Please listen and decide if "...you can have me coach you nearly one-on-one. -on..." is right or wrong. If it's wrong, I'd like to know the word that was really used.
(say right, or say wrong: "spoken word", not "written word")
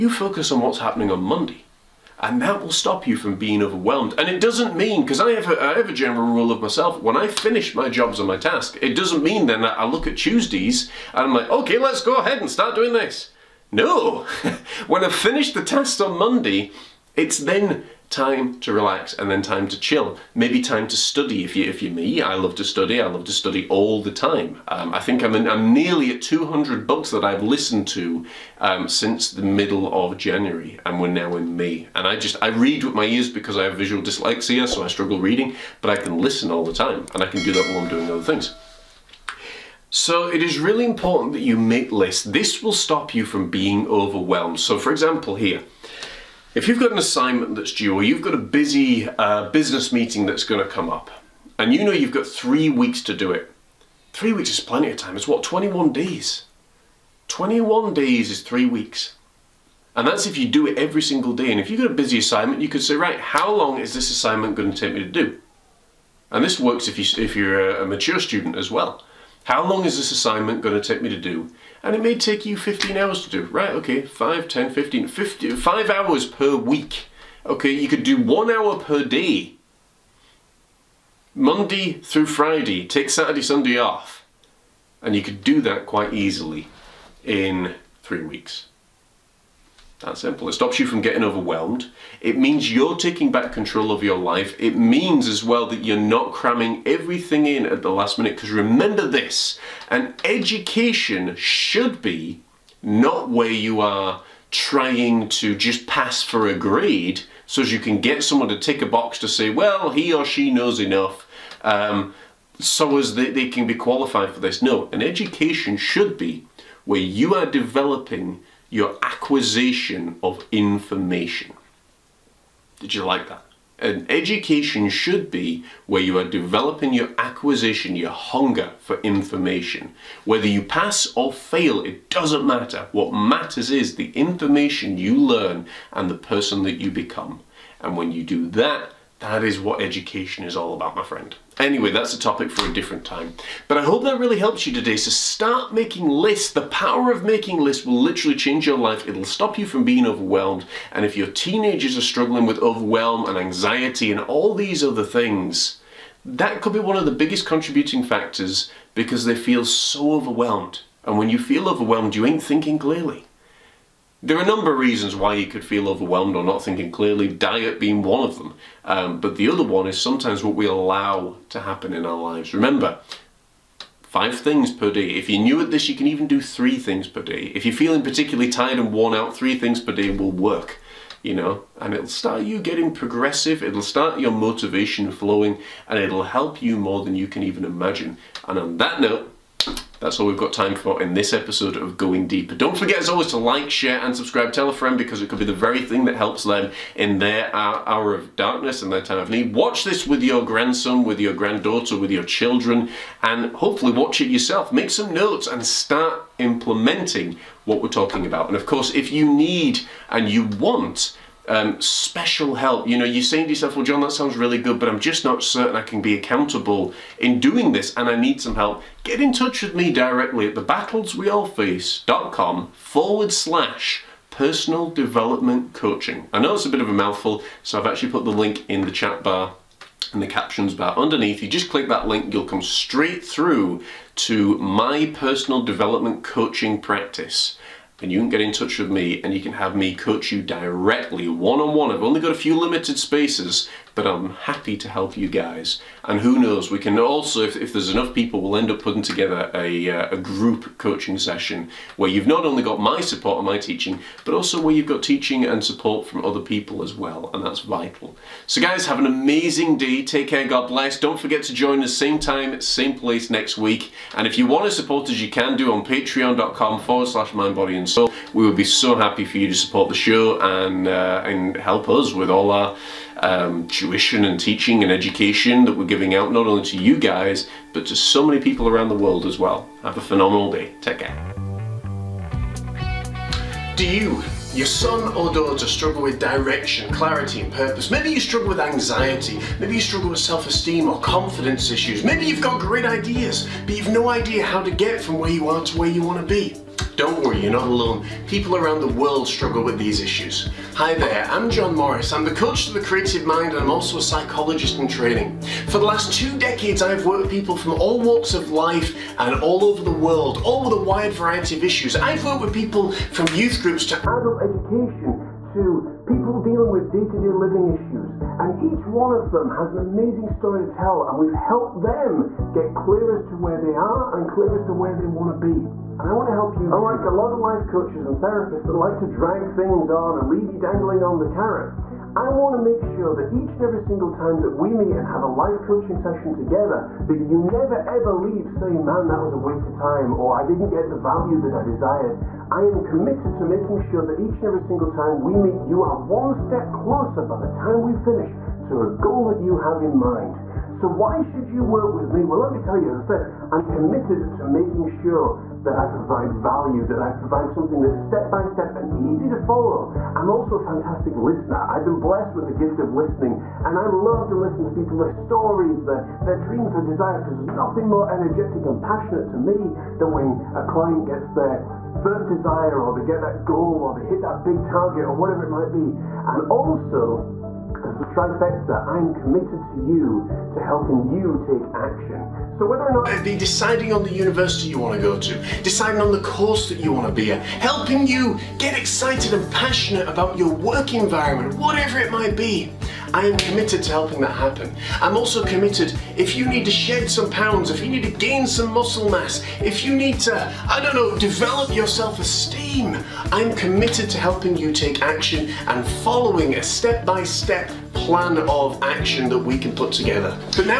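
wrong: "directly", not "nearly".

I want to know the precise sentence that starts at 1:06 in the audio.
And this works if, you, if you're a mature student as well.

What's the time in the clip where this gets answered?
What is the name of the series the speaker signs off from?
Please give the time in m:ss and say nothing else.
3:11.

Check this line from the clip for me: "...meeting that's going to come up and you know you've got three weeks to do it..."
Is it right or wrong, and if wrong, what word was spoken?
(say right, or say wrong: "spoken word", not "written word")
right.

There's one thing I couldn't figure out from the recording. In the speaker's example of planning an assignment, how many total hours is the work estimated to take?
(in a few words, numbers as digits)
15 hours.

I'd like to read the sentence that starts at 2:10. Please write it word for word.
Whether you pass or fail, it doesn't matter.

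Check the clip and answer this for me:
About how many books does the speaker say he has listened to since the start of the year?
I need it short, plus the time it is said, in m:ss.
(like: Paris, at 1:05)
200, at 0:26.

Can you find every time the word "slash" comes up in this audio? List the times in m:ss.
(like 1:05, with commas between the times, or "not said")
3:43, 4:27.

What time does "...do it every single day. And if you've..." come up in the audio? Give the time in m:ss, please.
1:00.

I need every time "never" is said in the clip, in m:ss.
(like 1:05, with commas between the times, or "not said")
5:37.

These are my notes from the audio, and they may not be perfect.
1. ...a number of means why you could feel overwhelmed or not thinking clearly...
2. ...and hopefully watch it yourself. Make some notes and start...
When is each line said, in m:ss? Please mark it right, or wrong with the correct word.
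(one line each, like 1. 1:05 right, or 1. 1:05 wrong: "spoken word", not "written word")
1. 2:44 wrong: "reasons", not "means"
2. 3:23 right.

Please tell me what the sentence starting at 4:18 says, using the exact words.
So guys, have an amazing day.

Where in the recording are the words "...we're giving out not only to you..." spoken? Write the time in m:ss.
4:35.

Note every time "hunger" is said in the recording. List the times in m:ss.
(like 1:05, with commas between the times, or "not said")
2:08.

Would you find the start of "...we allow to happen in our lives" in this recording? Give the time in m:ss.
2:50.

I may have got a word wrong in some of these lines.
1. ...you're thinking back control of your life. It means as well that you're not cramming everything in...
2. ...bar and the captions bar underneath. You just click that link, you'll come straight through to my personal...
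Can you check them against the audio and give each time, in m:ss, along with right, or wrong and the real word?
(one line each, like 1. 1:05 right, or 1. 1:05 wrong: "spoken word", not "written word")
1. 1:32 wrong: "taking", not "thinking"
2. 3:49 right.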